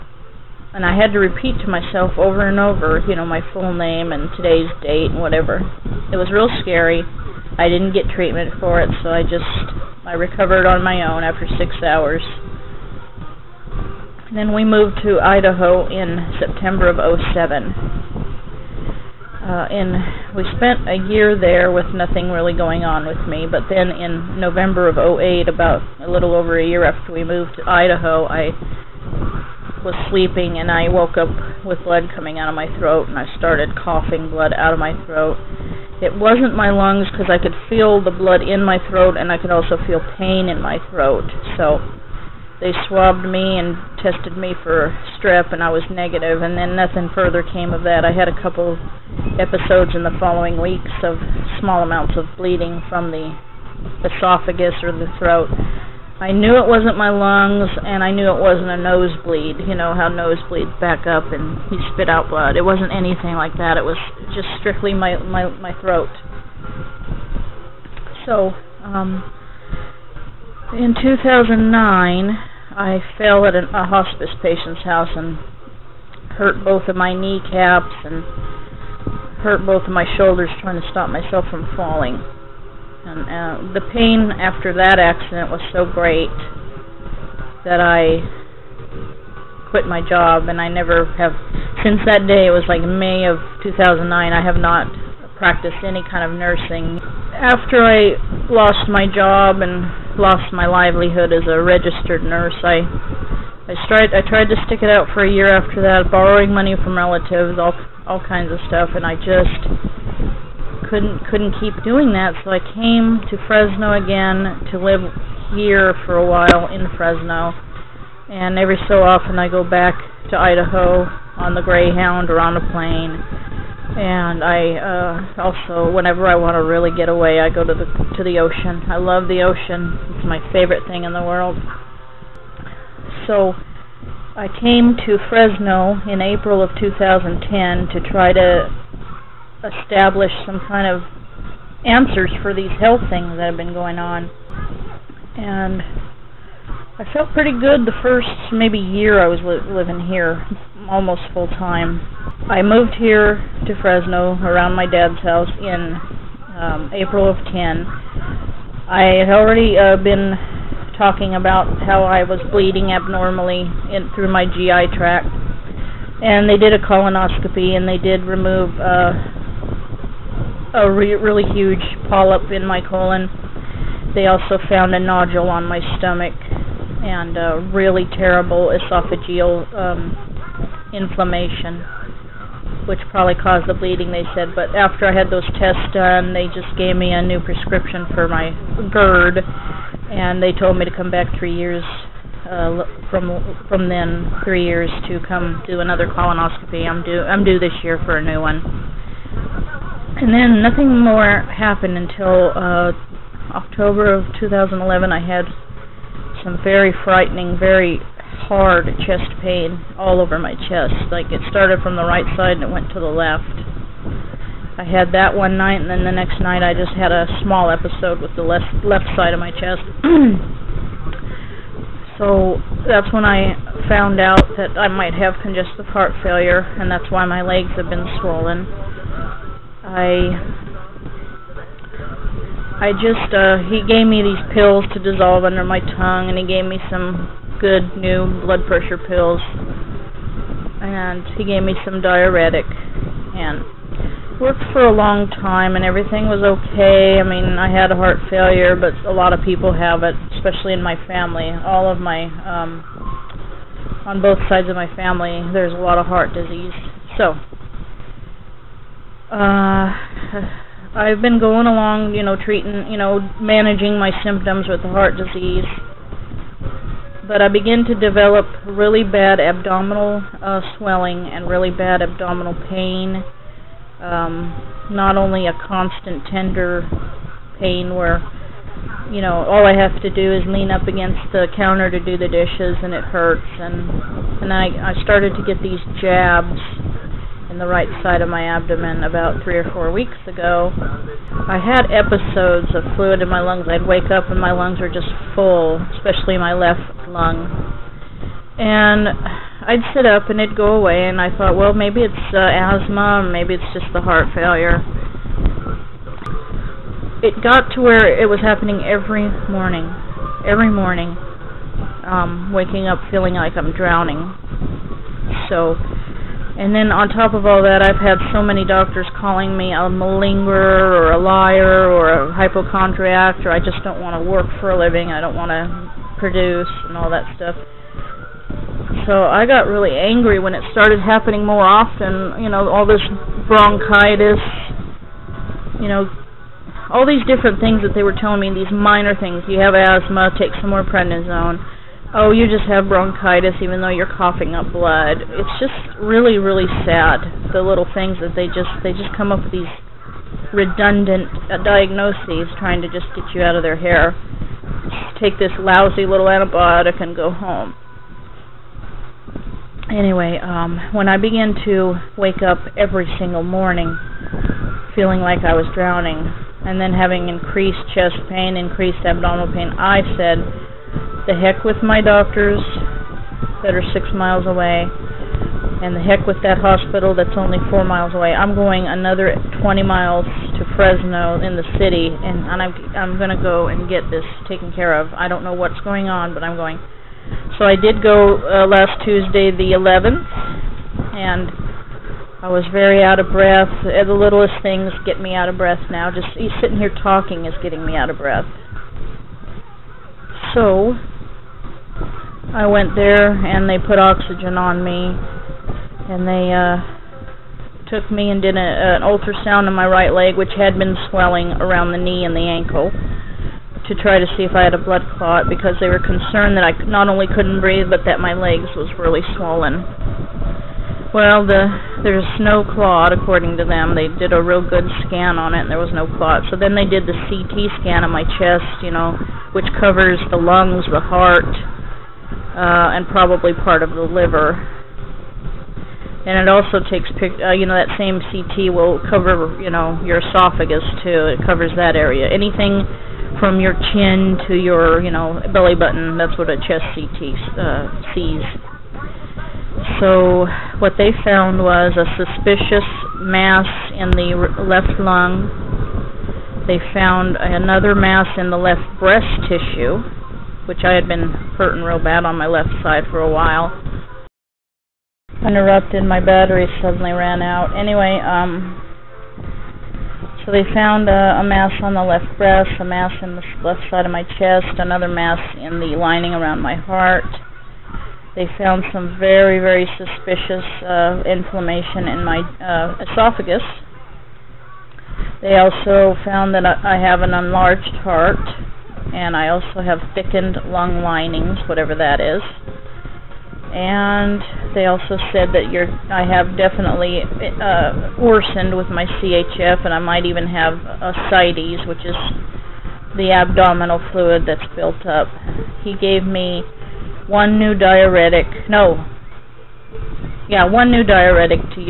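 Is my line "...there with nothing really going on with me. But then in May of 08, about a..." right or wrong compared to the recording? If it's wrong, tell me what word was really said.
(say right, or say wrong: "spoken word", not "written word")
wrong: "November", not "May".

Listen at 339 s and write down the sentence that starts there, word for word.
You have asthma, take some more prednisone oh, you just have bronchitis even though you're coughing up blood.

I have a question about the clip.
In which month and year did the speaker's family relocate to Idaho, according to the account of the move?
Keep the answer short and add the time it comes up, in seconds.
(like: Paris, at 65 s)
September 2007, at 16 s.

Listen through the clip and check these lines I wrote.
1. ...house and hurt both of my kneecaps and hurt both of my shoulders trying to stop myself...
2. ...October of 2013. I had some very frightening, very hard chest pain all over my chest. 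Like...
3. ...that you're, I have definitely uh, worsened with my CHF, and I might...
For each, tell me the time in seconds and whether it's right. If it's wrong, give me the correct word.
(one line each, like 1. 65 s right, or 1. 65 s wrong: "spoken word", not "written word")
1. 74 s right
2. 203 s wrong: "2011", not "2013"
3. 495 s right.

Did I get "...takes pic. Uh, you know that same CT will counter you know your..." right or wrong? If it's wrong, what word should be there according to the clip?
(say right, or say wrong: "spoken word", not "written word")
wrong: "cover", not "counter".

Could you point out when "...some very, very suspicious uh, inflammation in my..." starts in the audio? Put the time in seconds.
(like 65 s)
478 s.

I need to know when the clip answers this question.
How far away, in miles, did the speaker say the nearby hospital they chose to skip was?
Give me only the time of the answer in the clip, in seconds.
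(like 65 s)
377 s.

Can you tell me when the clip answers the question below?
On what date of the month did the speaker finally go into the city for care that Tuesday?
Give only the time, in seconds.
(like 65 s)
389 s.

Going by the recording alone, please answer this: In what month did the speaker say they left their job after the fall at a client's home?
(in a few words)
May.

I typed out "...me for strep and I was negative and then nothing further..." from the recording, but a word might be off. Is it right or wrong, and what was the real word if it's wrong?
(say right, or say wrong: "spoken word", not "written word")
right.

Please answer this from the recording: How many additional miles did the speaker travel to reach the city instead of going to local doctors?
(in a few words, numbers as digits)
20.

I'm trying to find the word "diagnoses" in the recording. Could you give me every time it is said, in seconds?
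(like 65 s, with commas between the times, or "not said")
351 s.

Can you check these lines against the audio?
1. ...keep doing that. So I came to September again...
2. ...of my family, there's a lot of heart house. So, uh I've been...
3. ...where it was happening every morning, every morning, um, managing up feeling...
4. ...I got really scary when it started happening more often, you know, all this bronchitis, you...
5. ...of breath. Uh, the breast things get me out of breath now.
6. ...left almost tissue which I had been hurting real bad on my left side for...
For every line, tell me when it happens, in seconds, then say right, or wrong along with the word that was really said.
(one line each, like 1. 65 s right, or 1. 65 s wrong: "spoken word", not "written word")
1. 111 s wrong: "Fresno", not "September"
2. 254 s wrong: "disease", not "house"
3. 307 s wrong: "waking", not "managing"
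4. 329 s wrong: "angry", not "scary"
5. 393 s wrong: "littlest", not "breast"
6. 458 s wrong: "breast", not "almost".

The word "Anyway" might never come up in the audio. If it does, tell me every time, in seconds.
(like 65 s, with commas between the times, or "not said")
359 s, 467 s.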